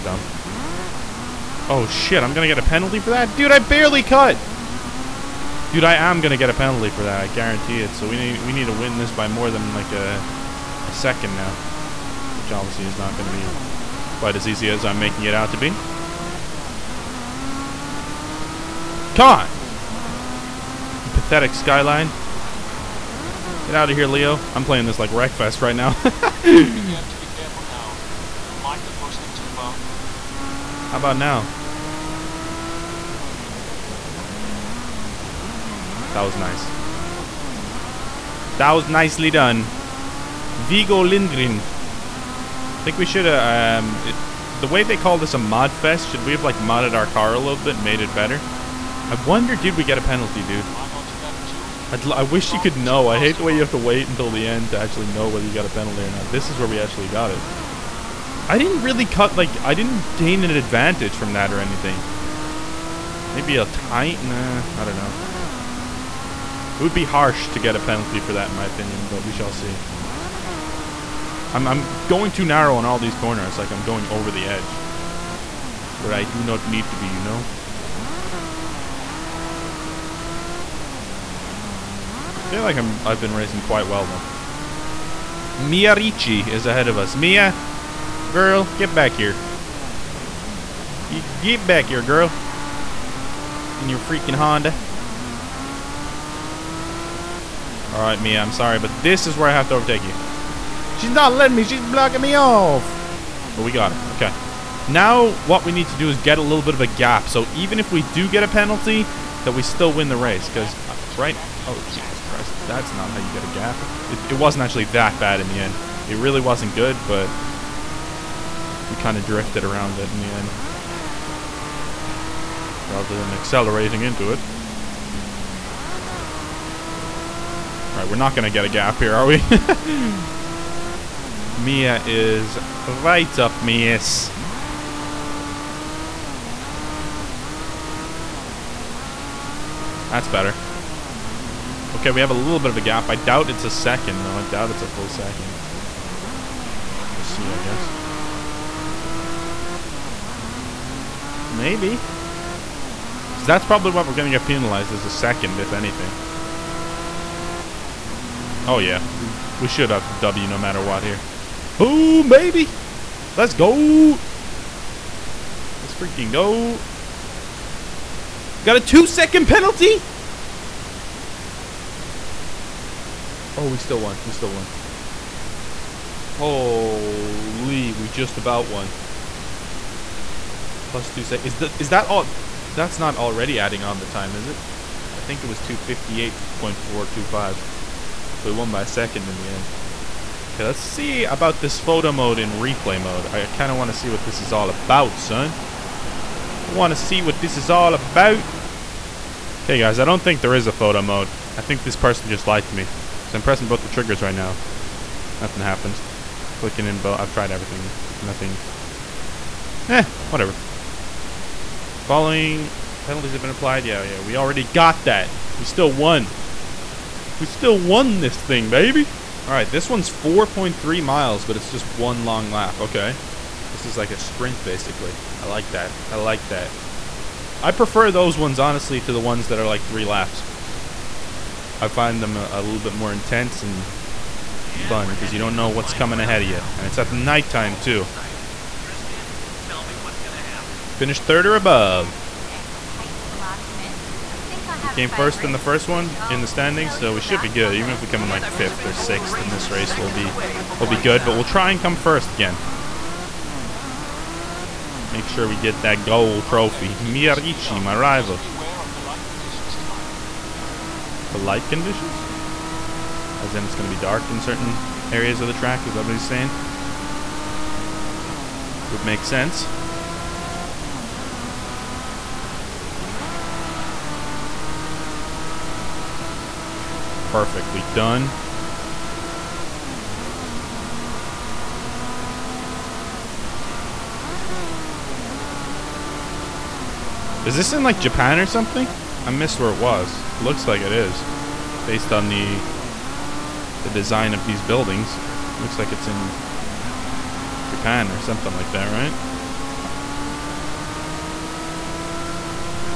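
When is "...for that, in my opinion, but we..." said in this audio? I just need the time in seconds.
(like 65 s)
68 s.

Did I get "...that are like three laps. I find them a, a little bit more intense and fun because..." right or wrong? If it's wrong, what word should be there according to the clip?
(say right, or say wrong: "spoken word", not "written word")
right.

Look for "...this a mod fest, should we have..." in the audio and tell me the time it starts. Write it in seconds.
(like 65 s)
45 s.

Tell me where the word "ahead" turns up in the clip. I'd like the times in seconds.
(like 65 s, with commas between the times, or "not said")
86 s, 236 s.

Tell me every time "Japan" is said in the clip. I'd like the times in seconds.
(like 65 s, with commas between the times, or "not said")
287 s, 297 s.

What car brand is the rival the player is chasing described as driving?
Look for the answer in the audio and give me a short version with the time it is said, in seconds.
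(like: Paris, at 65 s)
Honda, at 94 s.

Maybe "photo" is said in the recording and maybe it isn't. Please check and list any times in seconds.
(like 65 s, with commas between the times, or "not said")
191 s, 200 s.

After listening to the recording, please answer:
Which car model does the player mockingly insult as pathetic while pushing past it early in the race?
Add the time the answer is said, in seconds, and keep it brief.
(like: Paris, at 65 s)
Skyline, at 21 s.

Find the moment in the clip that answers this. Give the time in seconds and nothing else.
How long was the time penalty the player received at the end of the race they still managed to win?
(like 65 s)
168 s.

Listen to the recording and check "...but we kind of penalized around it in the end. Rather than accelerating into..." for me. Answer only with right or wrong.
wrong.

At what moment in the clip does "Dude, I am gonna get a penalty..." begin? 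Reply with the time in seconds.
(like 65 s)
5 s.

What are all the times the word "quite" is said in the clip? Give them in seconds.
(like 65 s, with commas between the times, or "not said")
14 s, 83 s.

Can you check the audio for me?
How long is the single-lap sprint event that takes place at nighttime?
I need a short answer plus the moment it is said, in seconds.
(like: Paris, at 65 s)
4.3 miles, at 220 s.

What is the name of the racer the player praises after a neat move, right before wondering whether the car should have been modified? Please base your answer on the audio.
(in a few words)
Vigo Lindgren.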